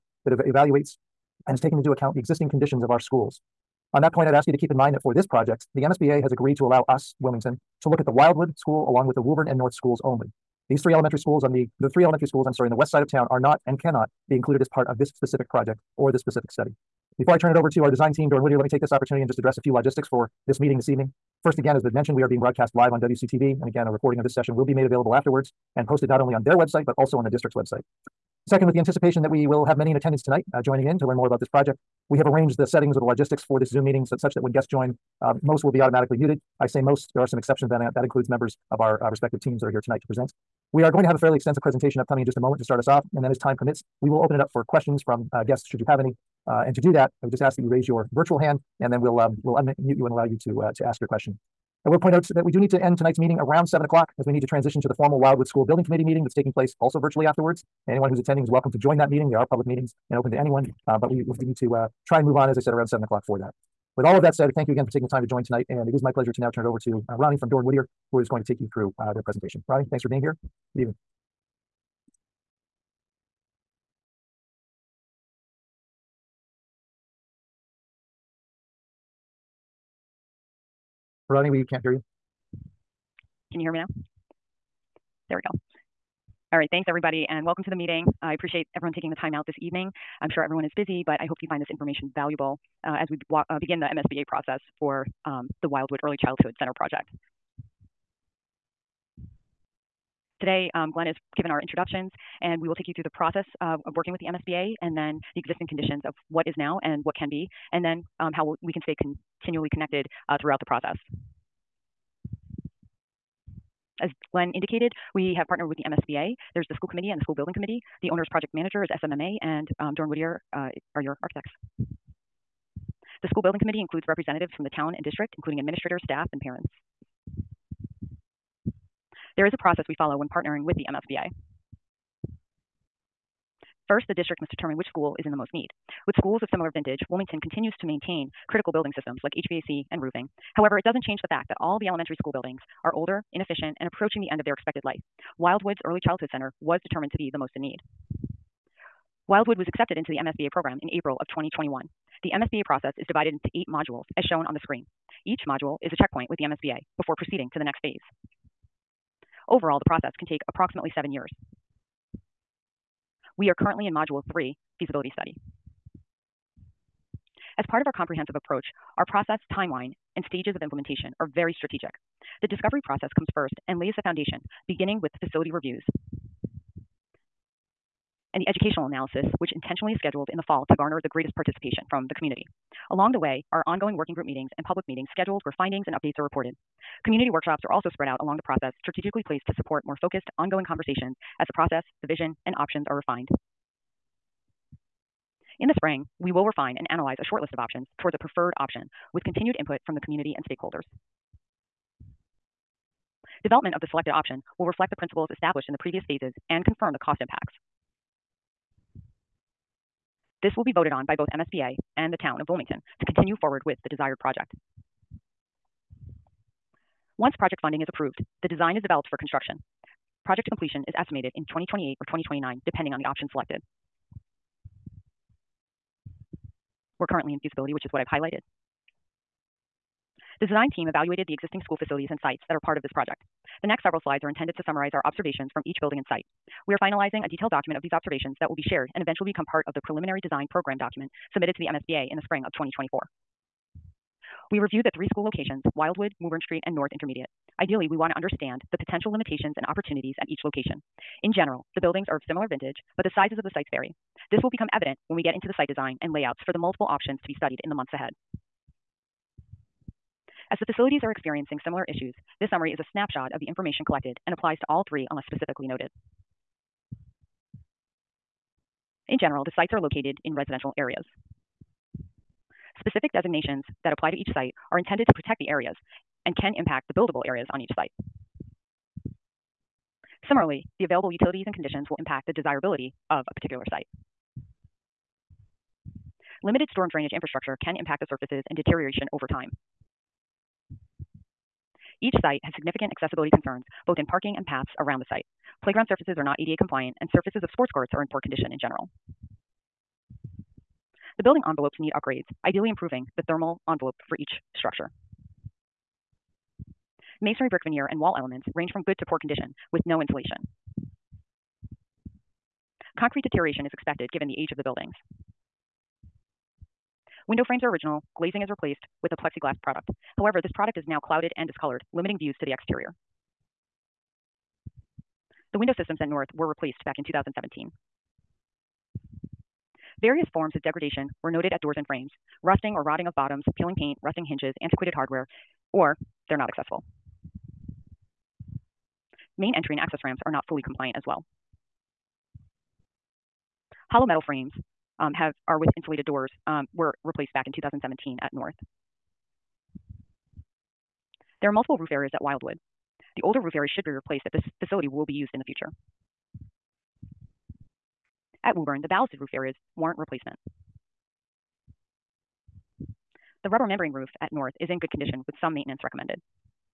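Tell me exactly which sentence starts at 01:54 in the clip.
As Glenn indicated, we have partnered with the MSBA.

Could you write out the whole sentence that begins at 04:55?
Playground surfaces are not ADA compliant, and surfaces of sports courts are in poor condition in general.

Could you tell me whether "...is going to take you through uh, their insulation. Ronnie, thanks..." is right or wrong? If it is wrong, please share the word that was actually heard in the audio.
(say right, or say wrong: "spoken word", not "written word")
wrong: "presentation", not "insulation".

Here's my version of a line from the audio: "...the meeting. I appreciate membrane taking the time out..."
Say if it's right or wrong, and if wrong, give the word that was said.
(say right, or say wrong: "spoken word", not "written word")
wrong: "everyone", not "membrane".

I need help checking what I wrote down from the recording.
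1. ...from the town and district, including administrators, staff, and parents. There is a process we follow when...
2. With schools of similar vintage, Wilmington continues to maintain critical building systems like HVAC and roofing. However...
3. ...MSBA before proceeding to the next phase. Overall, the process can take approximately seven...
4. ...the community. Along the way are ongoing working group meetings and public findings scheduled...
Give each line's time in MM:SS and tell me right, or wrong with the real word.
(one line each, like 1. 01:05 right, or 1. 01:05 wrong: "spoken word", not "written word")
1. 02:04 right
2. 02:16 right
3. 02:36 right
4. 03:02 wrong: "meetings", not "findings".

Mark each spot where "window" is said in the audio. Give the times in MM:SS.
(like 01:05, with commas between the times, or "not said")
05:17, 05:25.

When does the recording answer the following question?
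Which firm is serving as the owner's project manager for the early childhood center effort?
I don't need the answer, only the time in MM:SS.
01:59.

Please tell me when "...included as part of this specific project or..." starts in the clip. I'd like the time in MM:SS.
00:14.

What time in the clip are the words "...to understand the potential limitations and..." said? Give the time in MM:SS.
04:08.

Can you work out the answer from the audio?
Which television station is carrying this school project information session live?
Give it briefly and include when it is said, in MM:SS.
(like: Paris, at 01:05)
WCTV, at 00:23.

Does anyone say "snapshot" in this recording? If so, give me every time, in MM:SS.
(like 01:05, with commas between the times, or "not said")
04:22.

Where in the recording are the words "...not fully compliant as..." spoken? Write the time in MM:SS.
05:40.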